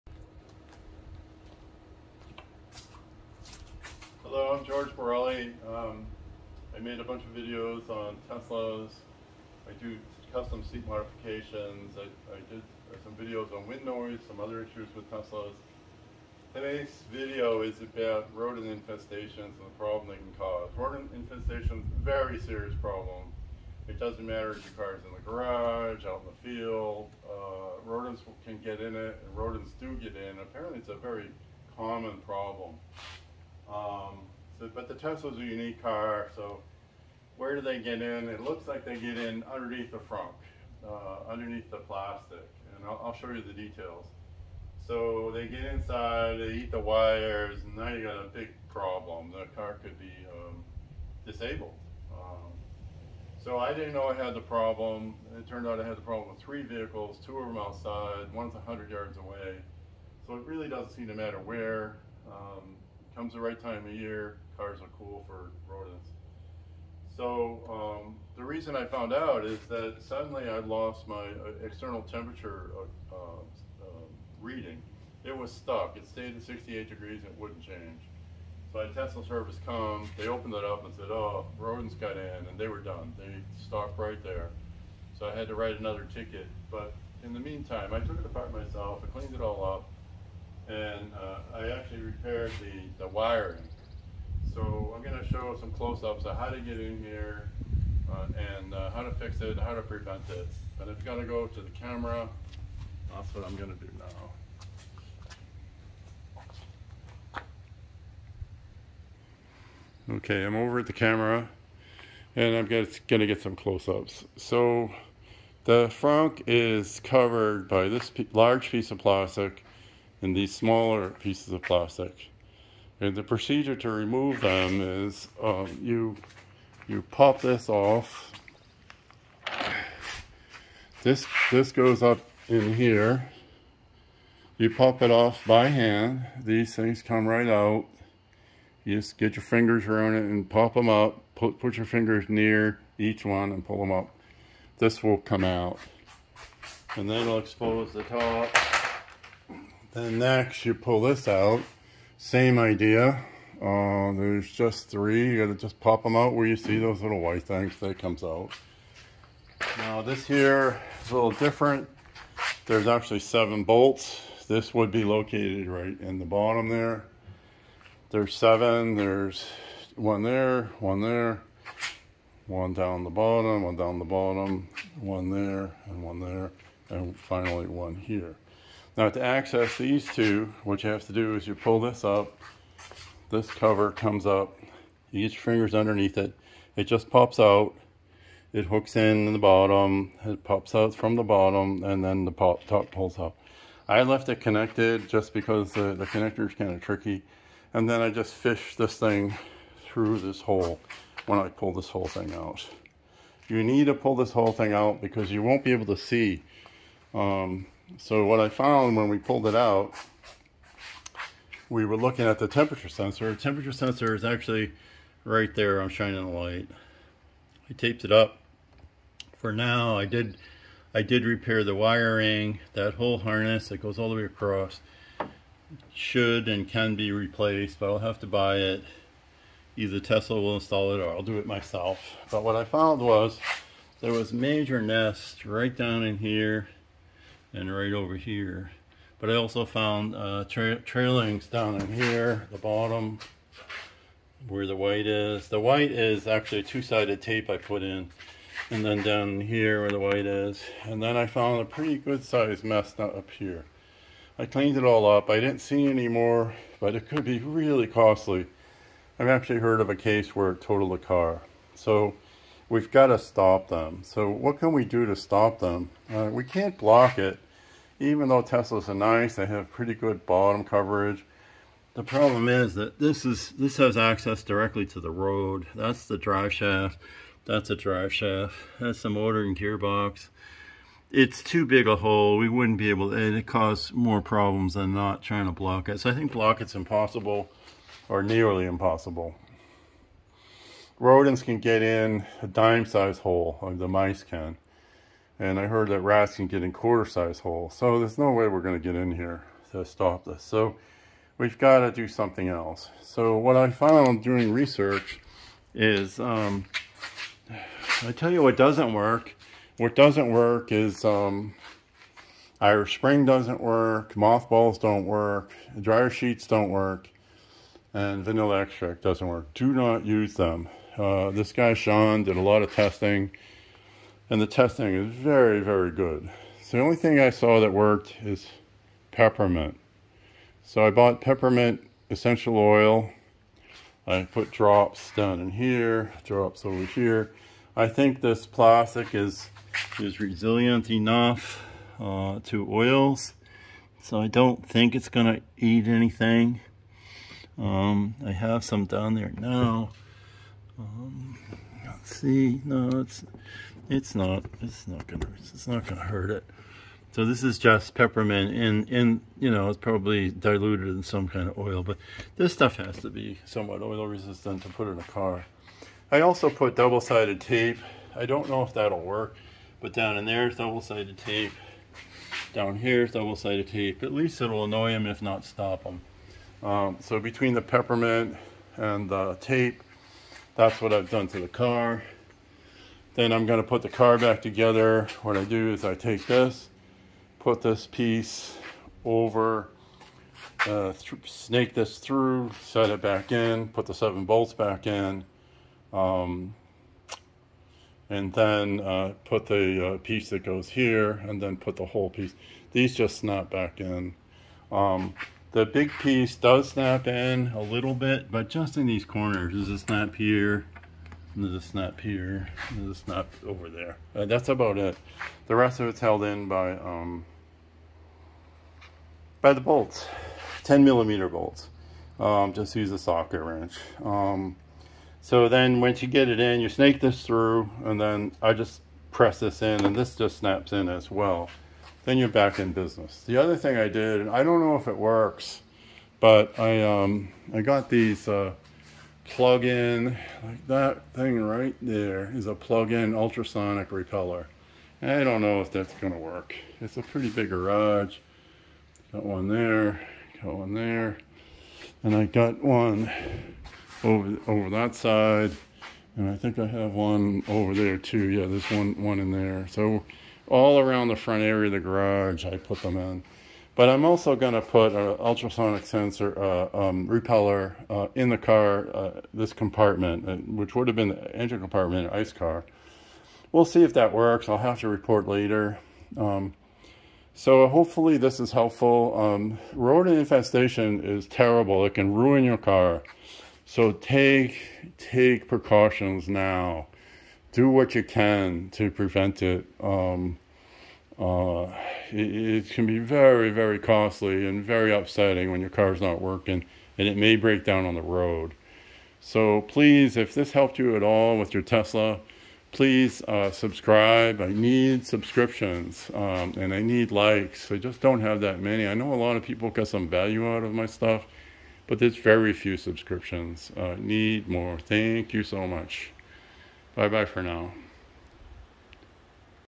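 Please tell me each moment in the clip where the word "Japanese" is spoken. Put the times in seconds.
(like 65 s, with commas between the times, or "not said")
not said.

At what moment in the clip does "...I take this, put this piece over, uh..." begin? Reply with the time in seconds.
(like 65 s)
385 s.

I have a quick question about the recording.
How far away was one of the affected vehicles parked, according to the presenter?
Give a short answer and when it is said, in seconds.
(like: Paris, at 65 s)
100 yards, at 58 s.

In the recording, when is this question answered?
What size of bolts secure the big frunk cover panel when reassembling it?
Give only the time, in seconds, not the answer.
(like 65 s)
420 s.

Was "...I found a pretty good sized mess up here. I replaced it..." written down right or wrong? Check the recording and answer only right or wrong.
wrong.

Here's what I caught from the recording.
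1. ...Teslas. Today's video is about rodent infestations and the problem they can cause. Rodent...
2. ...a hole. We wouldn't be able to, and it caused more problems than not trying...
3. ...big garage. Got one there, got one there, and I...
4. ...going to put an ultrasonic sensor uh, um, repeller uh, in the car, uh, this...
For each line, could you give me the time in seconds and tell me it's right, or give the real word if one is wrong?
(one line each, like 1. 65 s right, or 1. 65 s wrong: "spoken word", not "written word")
1. 15 s right
2. 281 s right
3. 447 s right
4. 464 s right.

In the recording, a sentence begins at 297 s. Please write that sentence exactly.
So there's no way we're going to get in here to stop this.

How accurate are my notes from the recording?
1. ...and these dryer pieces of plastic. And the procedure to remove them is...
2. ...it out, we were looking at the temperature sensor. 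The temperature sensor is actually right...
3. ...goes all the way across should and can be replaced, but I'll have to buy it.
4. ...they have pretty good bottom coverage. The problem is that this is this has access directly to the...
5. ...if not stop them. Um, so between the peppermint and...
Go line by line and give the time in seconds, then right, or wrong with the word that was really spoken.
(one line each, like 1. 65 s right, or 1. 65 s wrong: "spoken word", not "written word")
1. 120 s wrong: "smaller", not "dryer"
2. 209 s right
3. 223 s right
4. 269 s right
5. 375 s right.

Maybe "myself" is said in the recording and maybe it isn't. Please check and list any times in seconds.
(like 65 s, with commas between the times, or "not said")
88 s, 231 s.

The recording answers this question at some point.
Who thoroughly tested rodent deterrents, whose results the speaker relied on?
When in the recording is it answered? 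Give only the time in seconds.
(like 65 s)
321 s.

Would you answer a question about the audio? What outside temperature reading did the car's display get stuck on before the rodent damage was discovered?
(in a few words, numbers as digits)
68 degrees.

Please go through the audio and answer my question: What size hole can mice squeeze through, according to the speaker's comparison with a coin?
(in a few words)
dime-size.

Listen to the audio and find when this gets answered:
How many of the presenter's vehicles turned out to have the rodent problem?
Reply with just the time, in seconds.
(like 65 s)
56 s.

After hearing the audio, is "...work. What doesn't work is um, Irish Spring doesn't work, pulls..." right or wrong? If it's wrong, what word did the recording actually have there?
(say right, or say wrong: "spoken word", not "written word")
wrong: "mothballs", not "pulls".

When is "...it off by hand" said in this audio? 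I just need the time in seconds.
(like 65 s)
135 s.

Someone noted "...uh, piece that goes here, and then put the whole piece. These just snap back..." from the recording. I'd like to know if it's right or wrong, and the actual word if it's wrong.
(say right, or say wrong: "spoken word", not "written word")
right.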